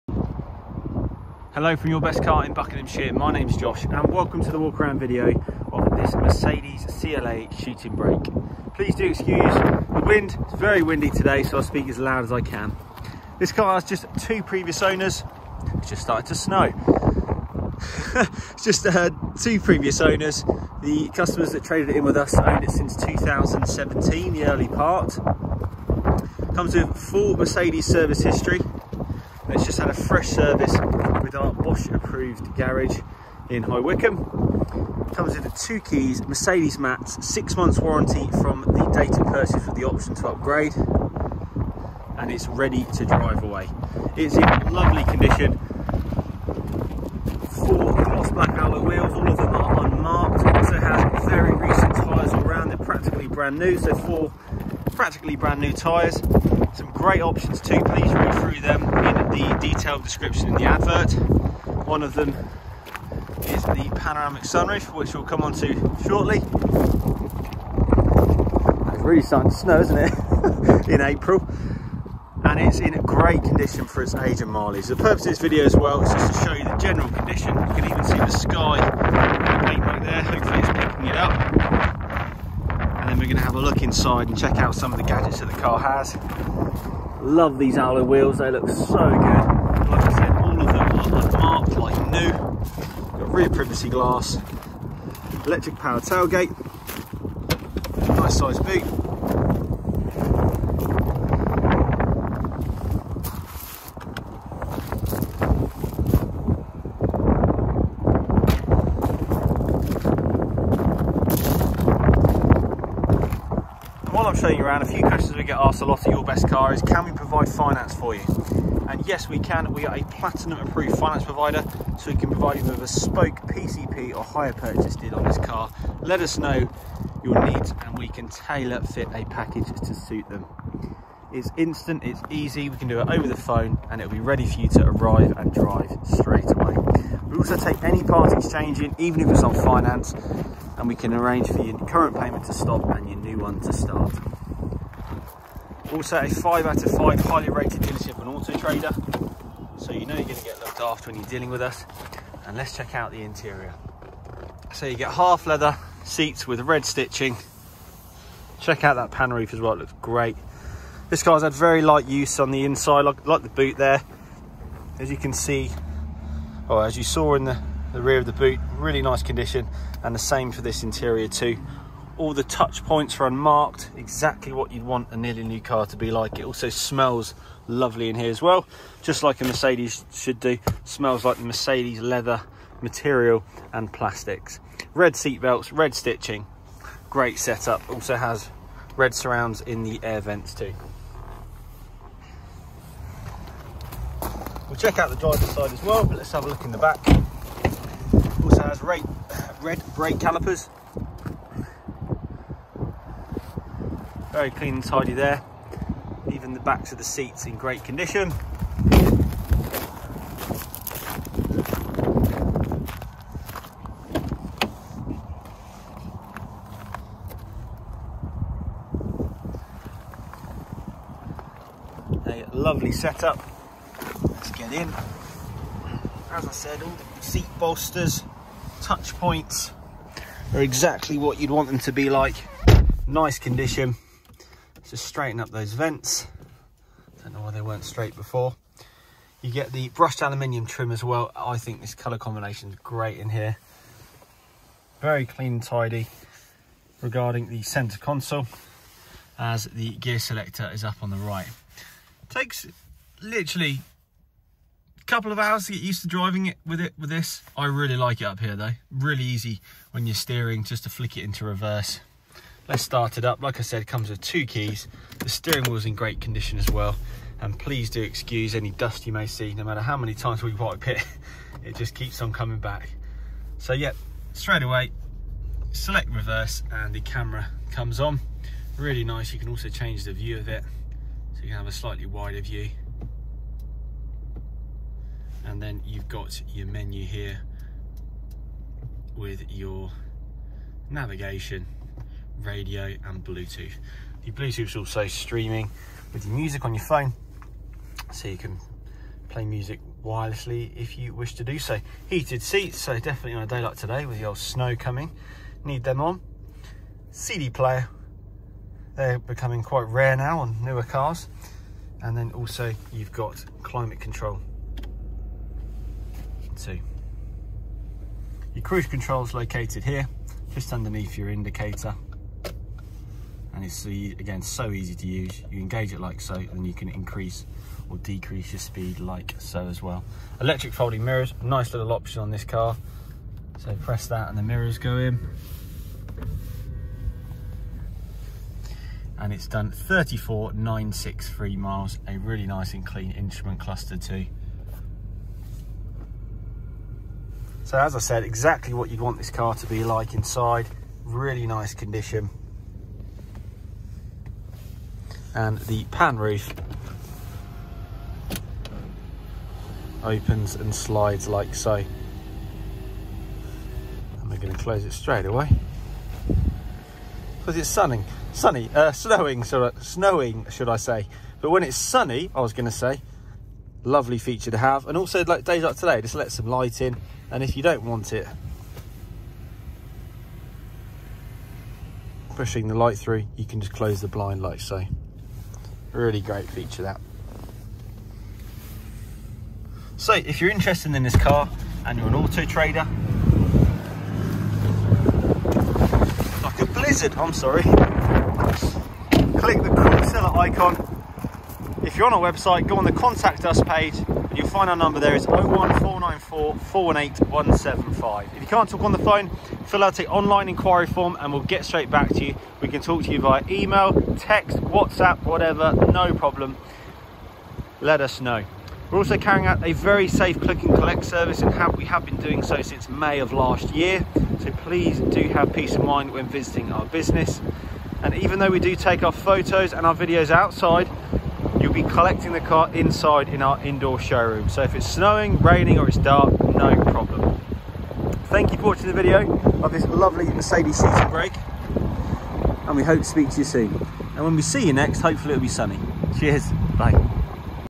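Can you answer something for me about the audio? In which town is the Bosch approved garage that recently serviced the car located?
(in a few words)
High Wycombe.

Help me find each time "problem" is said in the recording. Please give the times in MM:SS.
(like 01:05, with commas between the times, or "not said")
06:56, 07:16.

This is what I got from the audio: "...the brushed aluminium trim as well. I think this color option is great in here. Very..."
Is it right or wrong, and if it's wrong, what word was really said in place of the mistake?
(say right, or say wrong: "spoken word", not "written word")
wrong: "combination", not "option".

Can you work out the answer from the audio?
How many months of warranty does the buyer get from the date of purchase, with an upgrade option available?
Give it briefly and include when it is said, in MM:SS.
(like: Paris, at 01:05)
6, at 00:37.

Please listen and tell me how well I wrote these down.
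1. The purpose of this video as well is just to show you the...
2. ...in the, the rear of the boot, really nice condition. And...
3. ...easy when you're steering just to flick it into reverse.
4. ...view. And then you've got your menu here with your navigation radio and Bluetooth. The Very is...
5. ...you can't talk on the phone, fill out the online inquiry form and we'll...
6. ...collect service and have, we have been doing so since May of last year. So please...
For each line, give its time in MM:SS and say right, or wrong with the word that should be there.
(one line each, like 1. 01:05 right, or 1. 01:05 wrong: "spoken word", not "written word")
1. 01:14 right
2. 02:47 right
3. 04:19 right
4. 04:42 wrong: "Bluetooth", not "Very"
5. 06:48 right
6. 07:00 right.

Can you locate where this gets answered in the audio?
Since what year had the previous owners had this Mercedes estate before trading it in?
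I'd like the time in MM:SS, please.
00:22.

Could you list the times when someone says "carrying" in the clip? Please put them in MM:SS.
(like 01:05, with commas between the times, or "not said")
06:59.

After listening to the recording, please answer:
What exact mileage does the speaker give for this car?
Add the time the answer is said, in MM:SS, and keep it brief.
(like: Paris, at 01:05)
34,963 miles, at 05:39.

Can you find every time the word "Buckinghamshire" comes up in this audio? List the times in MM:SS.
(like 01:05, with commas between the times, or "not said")
00:02.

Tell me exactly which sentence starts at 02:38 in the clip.
Check out that pan roof as well, it looks great.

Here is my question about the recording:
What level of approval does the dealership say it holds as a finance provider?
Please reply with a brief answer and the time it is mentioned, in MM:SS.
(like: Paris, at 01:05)
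Platinum, at 02:00.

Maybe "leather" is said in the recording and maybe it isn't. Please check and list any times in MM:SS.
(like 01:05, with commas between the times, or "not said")
02:35, 03:01.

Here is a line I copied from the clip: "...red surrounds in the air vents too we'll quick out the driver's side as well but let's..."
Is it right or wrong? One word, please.
wrong.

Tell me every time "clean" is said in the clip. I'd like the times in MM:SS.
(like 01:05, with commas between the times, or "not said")
03:24, 04:05, 05:42.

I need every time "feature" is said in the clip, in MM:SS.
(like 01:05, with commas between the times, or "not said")
06:14, 06:26.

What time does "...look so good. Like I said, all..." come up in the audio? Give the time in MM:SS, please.
01:28.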